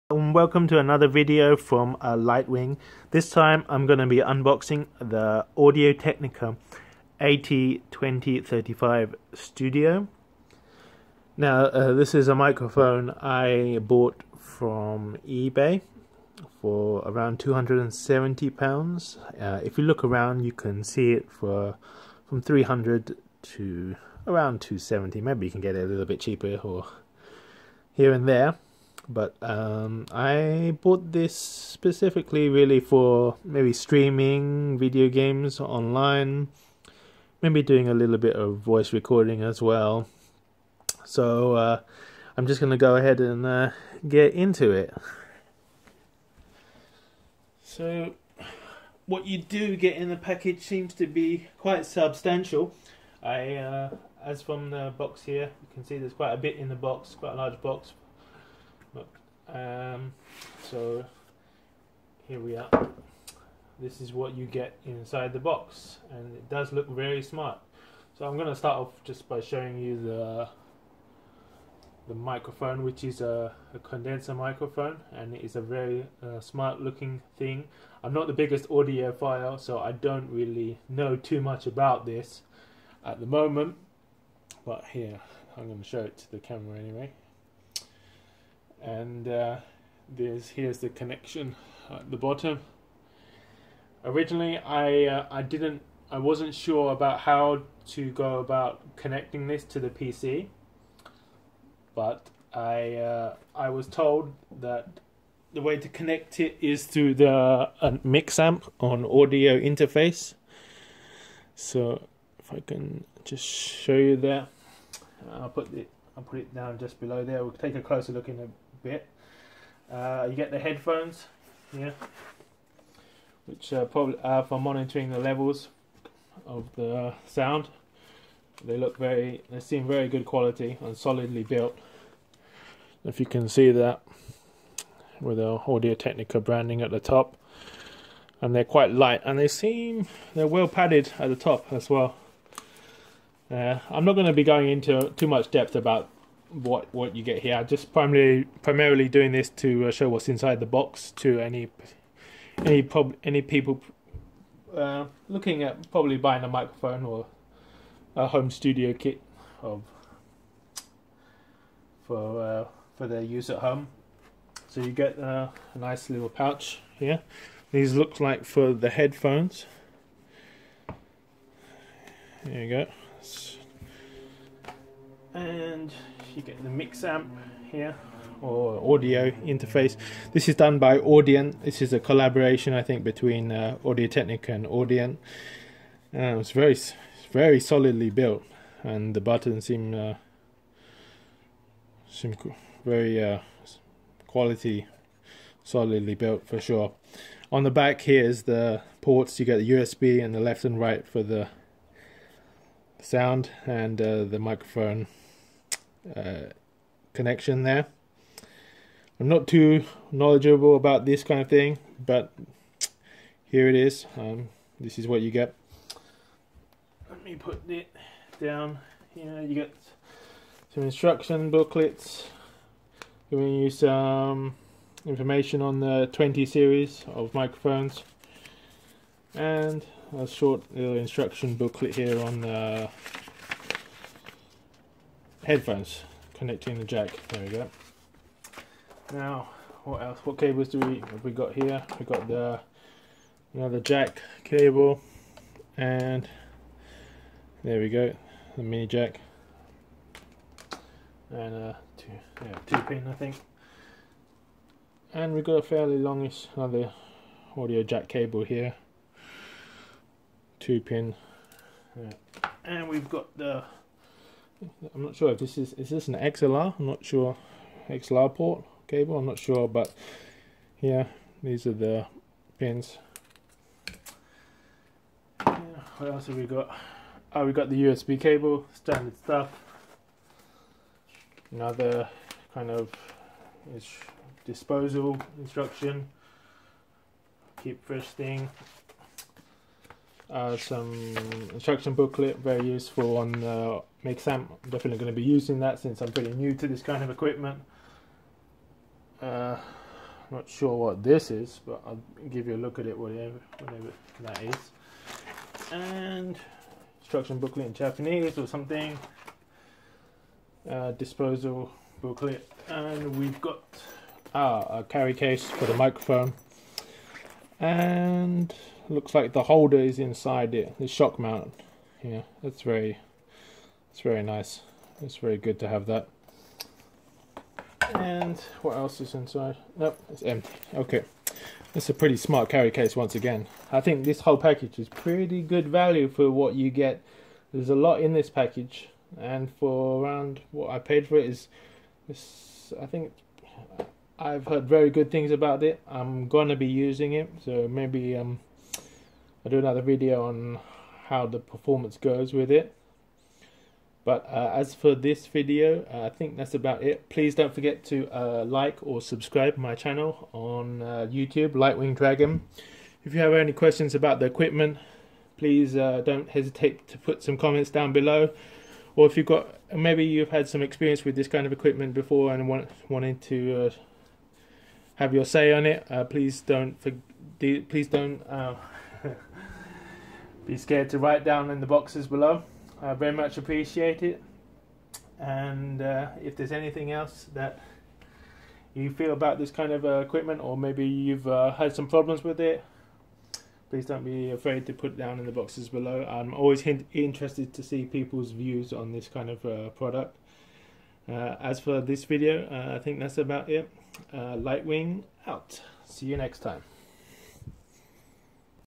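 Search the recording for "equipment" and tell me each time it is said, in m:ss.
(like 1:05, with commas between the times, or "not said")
4:57, 6:04, 6:11, 6:29.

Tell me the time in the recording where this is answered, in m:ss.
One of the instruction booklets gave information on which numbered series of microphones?
3:46.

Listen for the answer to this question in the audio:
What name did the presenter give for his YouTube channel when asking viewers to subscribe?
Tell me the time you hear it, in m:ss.
6:01.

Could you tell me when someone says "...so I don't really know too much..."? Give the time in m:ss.
1:19.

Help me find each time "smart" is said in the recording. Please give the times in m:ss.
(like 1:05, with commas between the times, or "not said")
1:07, 1:16, 5:32.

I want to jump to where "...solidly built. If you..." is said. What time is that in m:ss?
2:10.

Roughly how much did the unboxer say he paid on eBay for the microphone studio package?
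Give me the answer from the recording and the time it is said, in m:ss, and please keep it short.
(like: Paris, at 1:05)
270 pounds, at 0:17.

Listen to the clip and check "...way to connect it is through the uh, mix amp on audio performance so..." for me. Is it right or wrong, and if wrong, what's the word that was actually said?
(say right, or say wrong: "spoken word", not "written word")
wrong: "interface", not "performance".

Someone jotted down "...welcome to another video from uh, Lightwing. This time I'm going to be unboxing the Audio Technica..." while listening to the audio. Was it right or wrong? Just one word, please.
right.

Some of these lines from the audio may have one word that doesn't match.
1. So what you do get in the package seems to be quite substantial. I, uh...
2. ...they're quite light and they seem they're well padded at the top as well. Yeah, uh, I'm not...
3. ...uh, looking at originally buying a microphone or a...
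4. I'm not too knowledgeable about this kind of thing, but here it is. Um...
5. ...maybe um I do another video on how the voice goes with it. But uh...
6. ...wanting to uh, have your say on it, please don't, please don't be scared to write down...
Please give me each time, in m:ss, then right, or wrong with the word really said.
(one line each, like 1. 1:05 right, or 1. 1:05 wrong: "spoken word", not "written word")
1. 0:47 right
2. 2:18 right
3. 2:34 wrong: "probably", not "originally"
4. 3:29 right
5. 5:47 wrong: "performance", not "voice"
6. 6:12 right.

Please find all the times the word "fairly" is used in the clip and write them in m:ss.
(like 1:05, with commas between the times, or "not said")
4:15.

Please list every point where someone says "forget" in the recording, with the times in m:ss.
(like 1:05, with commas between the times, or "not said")
5:57.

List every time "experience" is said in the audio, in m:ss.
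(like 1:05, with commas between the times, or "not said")
6:10.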